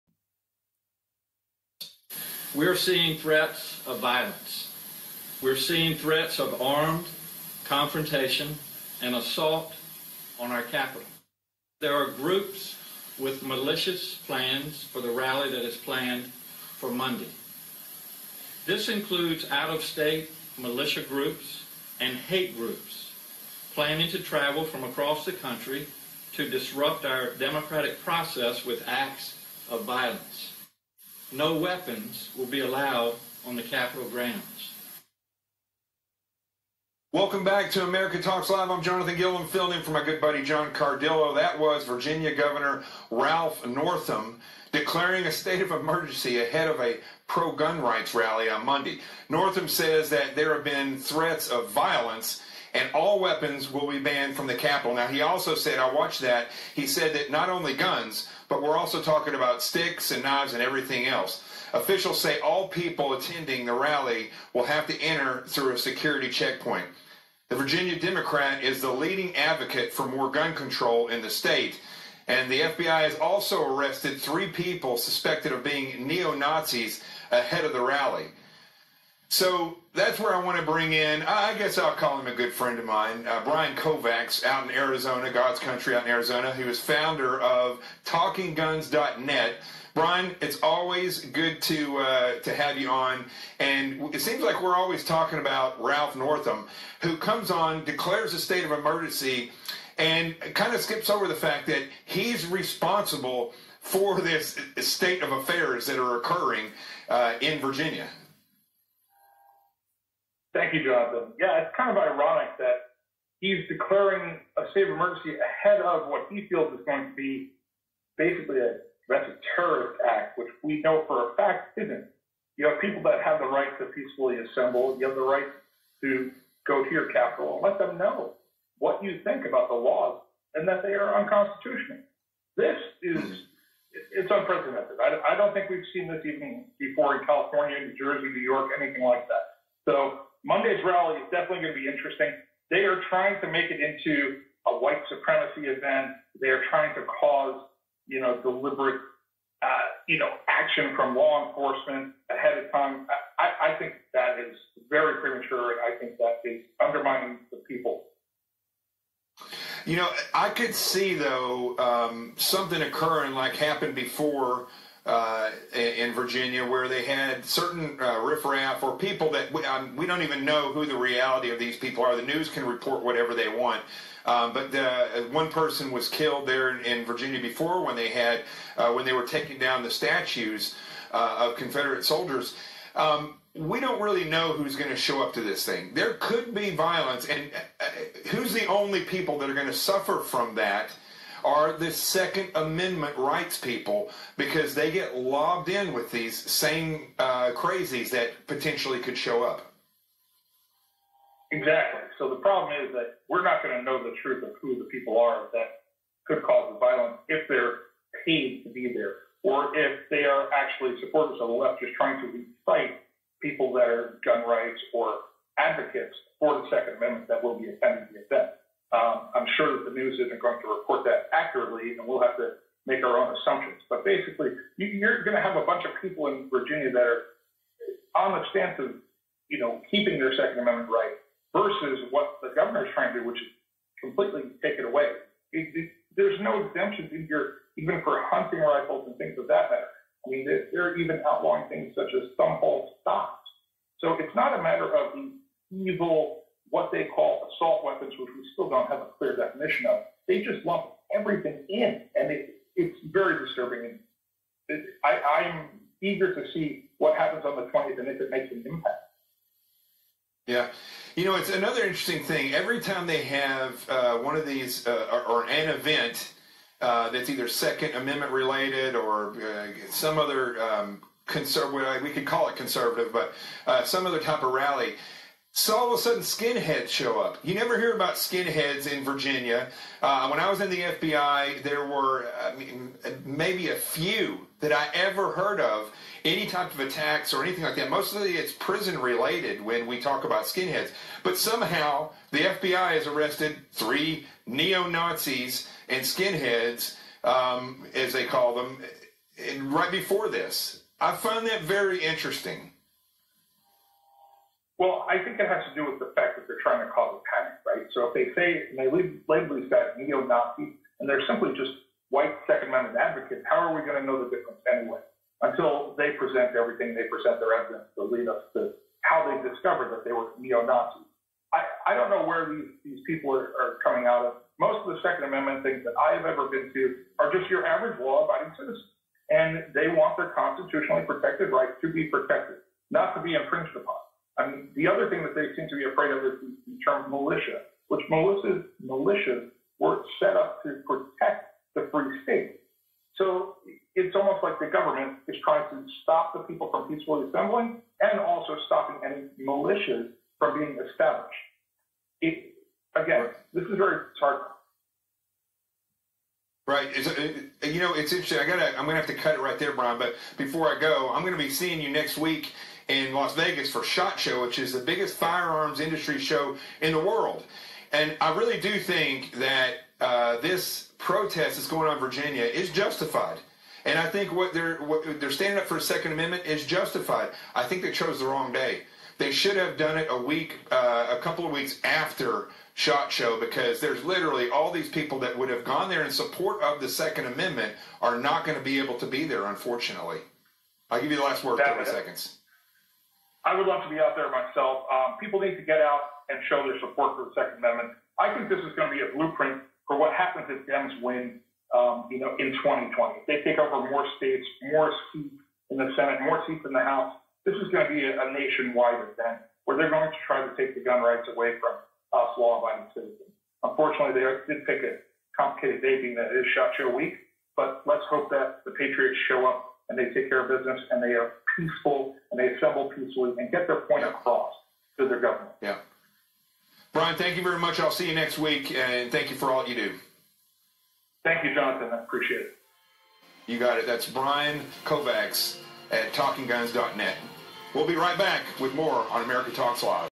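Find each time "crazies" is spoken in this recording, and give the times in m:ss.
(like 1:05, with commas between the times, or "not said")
3:17.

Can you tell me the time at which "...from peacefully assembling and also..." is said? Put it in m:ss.
5:46.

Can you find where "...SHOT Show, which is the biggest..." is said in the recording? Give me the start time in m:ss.
6:03.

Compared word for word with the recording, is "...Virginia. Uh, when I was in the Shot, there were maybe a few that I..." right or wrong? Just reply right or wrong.
wrong.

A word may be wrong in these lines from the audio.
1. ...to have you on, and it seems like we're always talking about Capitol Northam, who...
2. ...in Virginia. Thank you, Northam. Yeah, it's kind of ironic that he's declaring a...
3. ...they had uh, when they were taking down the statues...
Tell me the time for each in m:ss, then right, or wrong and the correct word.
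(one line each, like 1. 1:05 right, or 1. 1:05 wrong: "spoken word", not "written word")
1. 1:32 wrong: "Ralph", not "Capitol"
2. 1:47 wrong: "Jonathan", not "Northam"
3. 2:57 right.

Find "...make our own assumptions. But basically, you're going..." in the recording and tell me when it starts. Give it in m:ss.
3:42.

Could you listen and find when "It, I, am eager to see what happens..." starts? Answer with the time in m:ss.
4:14.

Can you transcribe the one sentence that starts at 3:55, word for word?
It, it, there's no exemptions in here, even for hunting rifles and things of that matter.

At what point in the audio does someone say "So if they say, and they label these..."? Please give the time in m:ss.
5:07.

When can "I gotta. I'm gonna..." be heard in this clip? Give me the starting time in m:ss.
5:58.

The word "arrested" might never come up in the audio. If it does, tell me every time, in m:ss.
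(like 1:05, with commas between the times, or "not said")
1:13, 4:53.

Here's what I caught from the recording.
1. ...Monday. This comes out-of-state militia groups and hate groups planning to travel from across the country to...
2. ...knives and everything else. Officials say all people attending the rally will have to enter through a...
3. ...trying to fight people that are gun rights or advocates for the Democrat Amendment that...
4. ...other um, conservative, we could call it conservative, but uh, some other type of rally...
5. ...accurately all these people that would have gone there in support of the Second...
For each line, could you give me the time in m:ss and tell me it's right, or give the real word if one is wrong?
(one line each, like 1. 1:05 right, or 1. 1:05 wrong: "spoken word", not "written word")
1. 0:16 wrong: "includes", not "comes"
2. 1:00 right
3. 3:31 wrong: "Second", not "Democrat"
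4. 4:30 right
5. 6:24 wrong: "literally", not "accurately".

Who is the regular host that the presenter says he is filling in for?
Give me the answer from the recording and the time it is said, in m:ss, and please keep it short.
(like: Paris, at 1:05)
John Cardillo, at 0:40.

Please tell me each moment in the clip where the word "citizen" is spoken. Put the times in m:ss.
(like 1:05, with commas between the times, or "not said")
5:28, 6:52.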